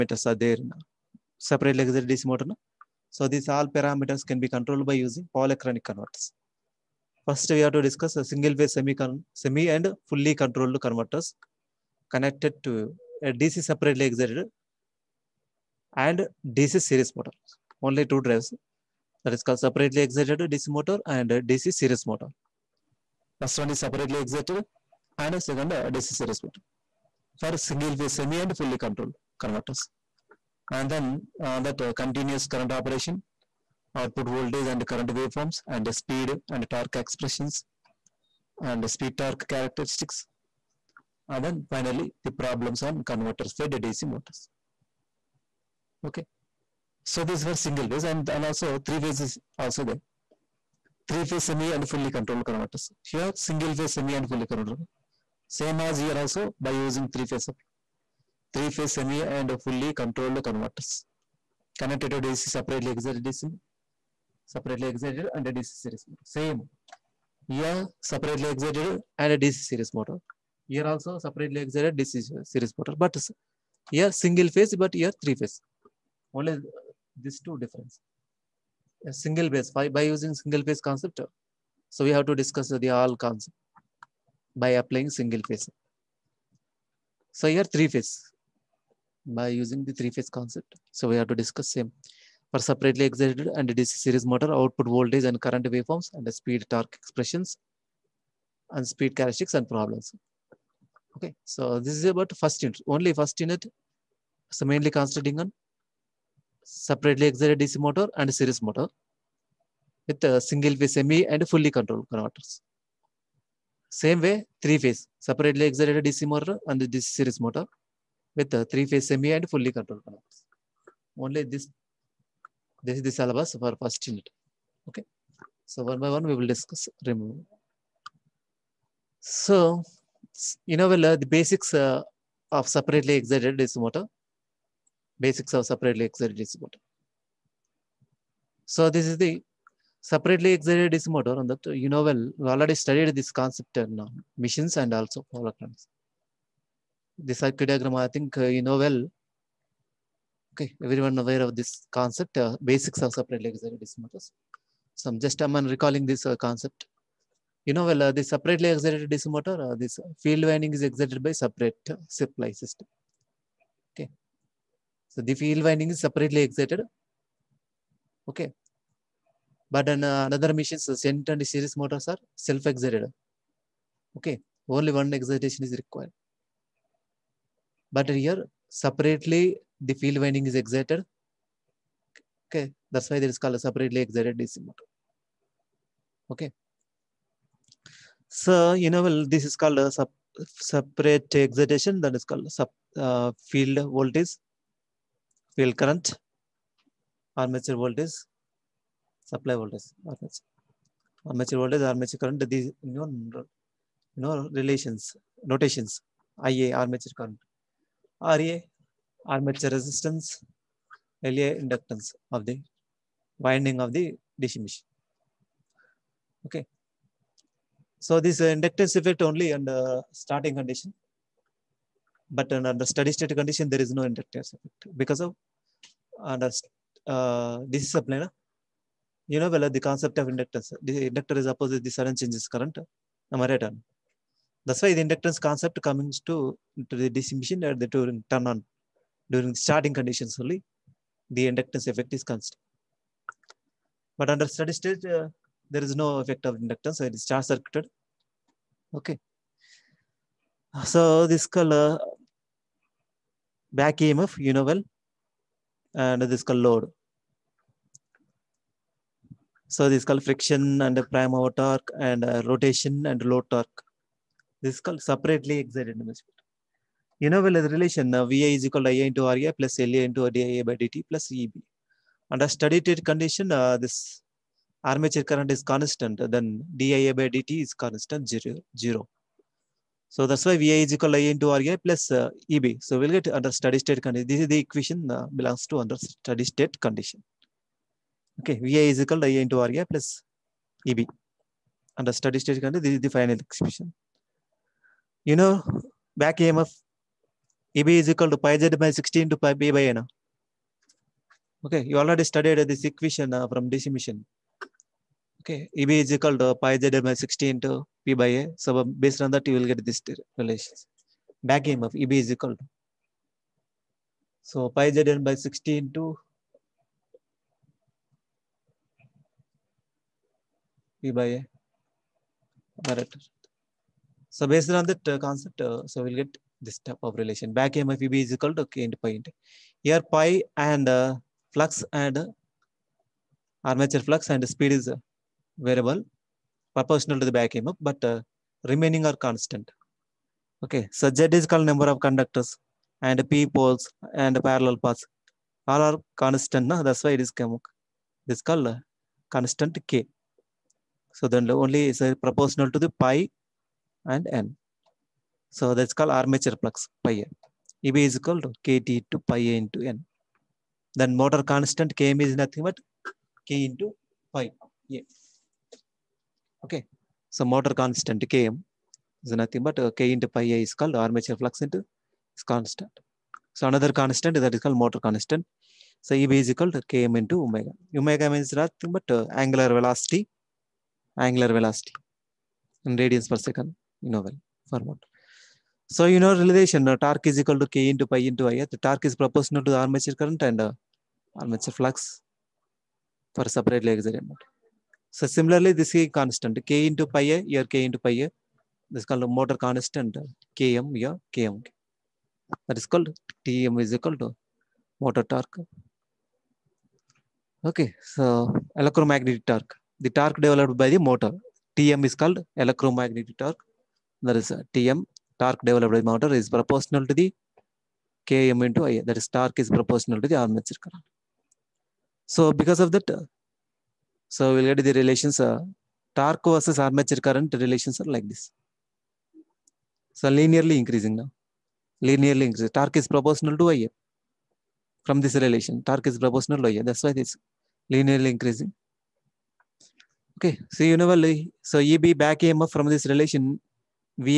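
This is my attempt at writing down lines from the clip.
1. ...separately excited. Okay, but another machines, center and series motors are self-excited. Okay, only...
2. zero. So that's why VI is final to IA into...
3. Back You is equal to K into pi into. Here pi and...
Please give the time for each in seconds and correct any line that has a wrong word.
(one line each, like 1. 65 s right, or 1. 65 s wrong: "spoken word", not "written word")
1. 166 s right
2. 278 s wrong: "equal", not "final"
3. 327 s wrong: "MFEB", not "You".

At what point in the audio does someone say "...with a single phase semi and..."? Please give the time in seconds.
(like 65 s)
110 s.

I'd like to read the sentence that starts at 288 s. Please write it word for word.
Okay, VI is equal to IA into RA plus EB.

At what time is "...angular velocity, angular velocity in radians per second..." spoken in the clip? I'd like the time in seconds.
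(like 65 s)
379 s.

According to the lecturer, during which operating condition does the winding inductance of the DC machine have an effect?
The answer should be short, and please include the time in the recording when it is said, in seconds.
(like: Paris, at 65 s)
Starting condition, at 220 s.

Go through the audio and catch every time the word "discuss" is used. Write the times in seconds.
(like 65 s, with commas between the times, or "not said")
7 s, 82 s, 91 s, 126 s.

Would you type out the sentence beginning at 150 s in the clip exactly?
Okay, everyone aware of this concept, uh, basics of separately excited motors.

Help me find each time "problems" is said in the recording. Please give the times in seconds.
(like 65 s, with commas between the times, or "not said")
42 s, 99 s.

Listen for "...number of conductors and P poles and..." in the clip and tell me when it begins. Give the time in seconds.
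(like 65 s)
341 s.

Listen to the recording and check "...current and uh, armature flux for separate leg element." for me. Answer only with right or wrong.
right.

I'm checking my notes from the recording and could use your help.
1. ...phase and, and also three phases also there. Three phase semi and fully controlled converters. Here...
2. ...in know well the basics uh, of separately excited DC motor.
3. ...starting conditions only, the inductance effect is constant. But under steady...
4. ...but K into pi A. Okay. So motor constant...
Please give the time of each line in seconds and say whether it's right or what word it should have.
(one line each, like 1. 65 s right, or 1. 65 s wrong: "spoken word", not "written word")
1. 47 s right
2. 130 s right
3. 239 s right
4. 362 s right.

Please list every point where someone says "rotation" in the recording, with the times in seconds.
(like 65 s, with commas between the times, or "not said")
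262 s.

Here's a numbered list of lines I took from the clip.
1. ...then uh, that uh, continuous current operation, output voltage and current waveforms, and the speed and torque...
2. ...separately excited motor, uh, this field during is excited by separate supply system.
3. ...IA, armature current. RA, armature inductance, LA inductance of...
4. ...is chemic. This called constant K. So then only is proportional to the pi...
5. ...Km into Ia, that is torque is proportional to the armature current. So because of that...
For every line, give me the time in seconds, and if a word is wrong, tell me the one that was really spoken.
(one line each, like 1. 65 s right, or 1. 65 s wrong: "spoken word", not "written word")
1. 30 s right
2. 158 s wrong: "winding", not "during"
3. 206 s wrong: "resistance", not "inductance"
4. 347 s right
5. 418 s right.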